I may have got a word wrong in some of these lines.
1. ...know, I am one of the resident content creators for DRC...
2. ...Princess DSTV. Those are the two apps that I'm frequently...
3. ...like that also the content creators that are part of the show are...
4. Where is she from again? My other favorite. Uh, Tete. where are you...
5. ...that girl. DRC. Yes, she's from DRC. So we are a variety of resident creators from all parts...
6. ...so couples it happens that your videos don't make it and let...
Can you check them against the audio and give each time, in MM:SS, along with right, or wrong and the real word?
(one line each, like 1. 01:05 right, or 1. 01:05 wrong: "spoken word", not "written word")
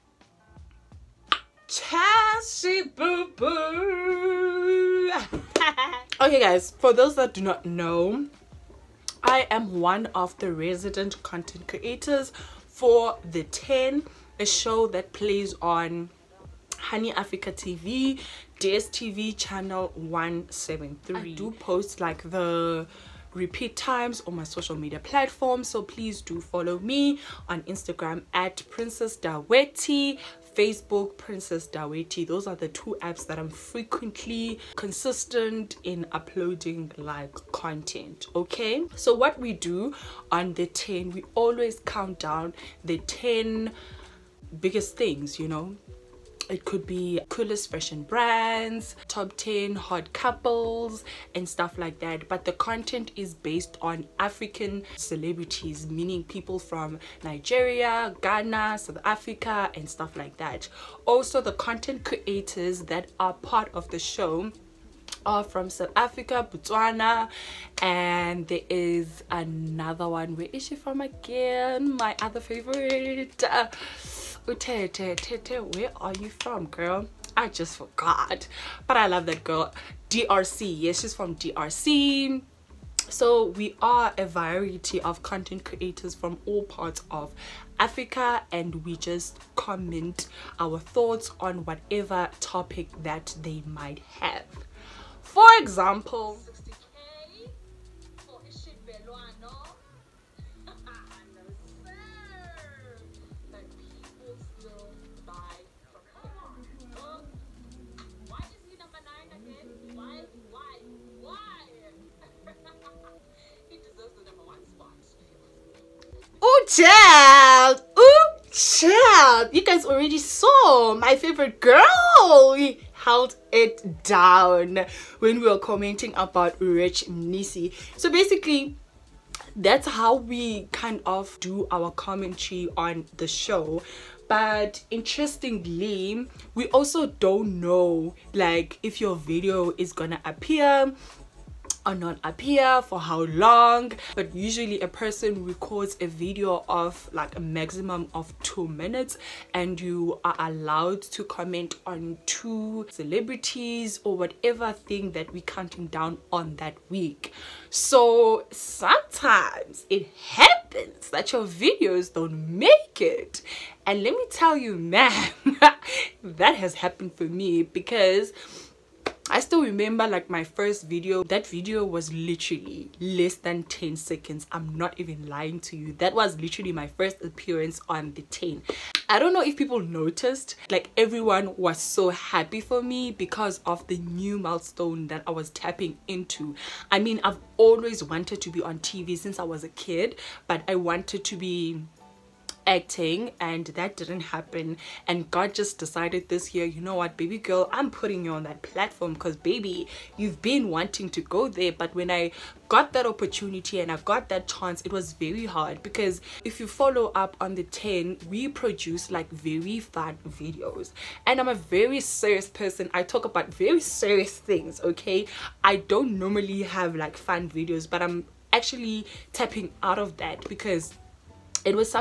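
1. 00:07 wrong: "The", not "DRC"
2. 00:31 wrong: "Daweti", not "DSTV"
3. 01:00 right
4. 01:10 right
5. 01:19 wrong: "content", not "resident"
6. 02:37 wrong: "sometimes", not "couples".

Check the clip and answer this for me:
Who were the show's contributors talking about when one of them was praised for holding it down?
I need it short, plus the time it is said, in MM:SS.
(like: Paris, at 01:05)
Rich Mnisi, at 02:06.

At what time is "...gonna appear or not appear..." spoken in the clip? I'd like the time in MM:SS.
02:19.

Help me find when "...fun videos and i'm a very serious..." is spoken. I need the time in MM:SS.
03:29.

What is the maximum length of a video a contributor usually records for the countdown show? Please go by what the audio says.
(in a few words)
2 minutes.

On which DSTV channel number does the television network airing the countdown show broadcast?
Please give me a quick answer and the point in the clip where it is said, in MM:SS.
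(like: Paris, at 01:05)
173, at 00:18.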